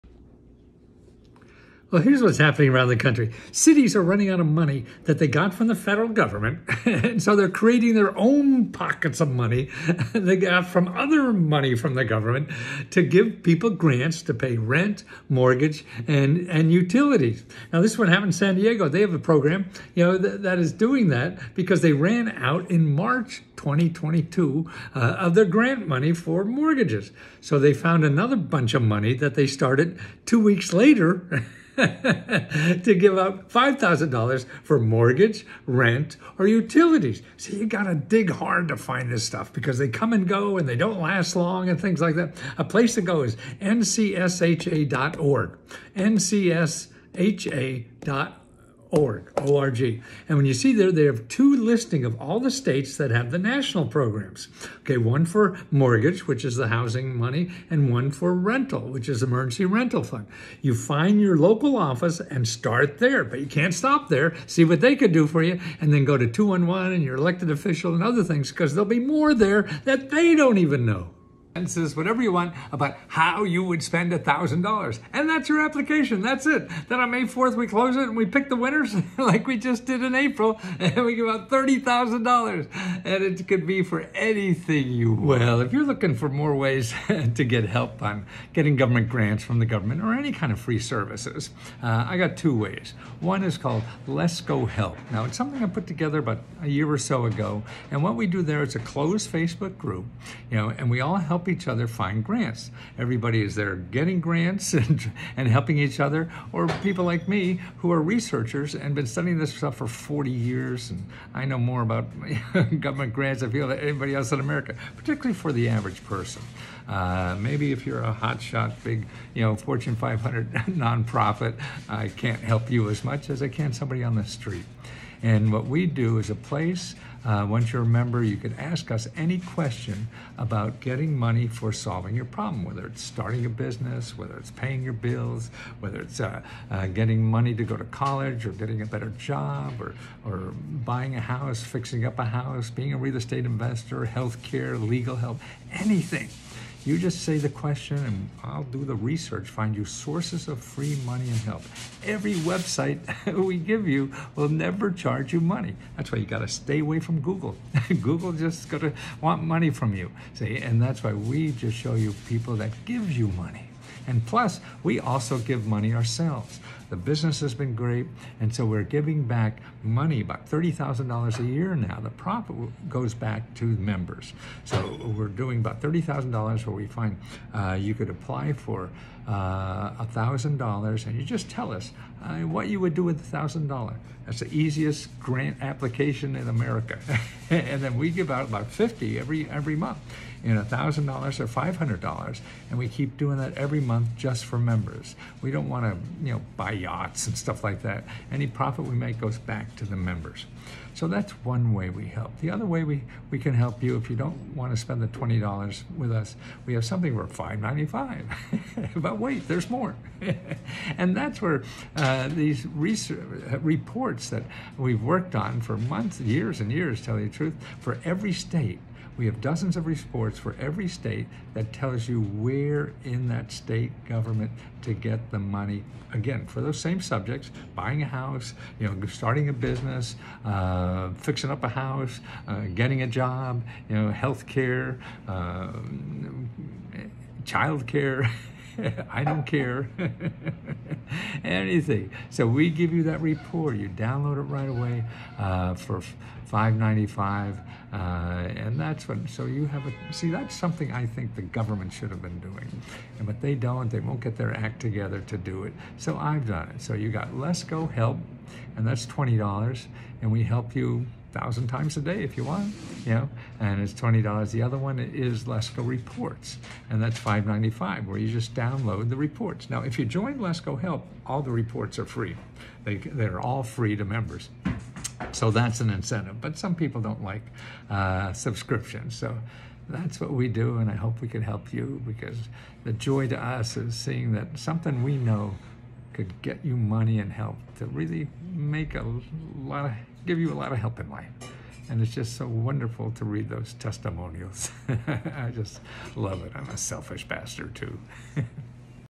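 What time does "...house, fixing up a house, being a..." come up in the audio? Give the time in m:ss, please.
2:21.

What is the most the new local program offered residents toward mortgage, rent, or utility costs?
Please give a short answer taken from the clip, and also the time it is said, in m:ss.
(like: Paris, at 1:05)
$5,000, at 0:33.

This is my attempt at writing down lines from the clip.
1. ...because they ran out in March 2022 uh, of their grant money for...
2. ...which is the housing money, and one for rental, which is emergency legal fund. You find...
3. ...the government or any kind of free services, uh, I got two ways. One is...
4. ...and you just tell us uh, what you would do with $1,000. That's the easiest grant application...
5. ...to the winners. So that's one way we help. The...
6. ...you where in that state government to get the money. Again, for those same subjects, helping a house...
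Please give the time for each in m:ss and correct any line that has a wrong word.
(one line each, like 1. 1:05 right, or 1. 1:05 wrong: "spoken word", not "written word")
1. 0:21 right
2. 0:56 wrong: "rental", not "legal"
3. 1:29 right
4. 3:01 right
5. 3:19 wrong: "members", not "winners"
6. 3:42 wrong: "buying", not "helping".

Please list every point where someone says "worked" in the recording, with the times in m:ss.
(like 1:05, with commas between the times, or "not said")
3:35.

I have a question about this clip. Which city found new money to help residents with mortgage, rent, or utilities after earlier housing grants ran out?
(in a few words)
San Diego.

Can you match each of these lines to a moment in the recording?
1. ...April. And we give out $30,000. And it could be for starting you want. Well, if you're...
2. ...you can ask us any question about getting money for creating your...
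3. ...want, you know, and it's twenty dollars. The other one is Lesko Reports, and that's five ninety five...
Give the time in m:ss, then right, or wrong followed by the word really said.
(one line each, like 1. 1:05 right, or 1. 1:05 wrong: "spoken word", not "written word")
1. 1:20 wrong: "anything", not "starting"
2. 2:08 wrong: "solving", not "creating"
3. 4:22 right.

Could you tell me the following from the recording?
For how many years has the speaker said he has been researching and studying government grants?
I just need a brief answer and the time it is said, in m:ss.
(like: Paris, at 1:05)
40, at 1:49.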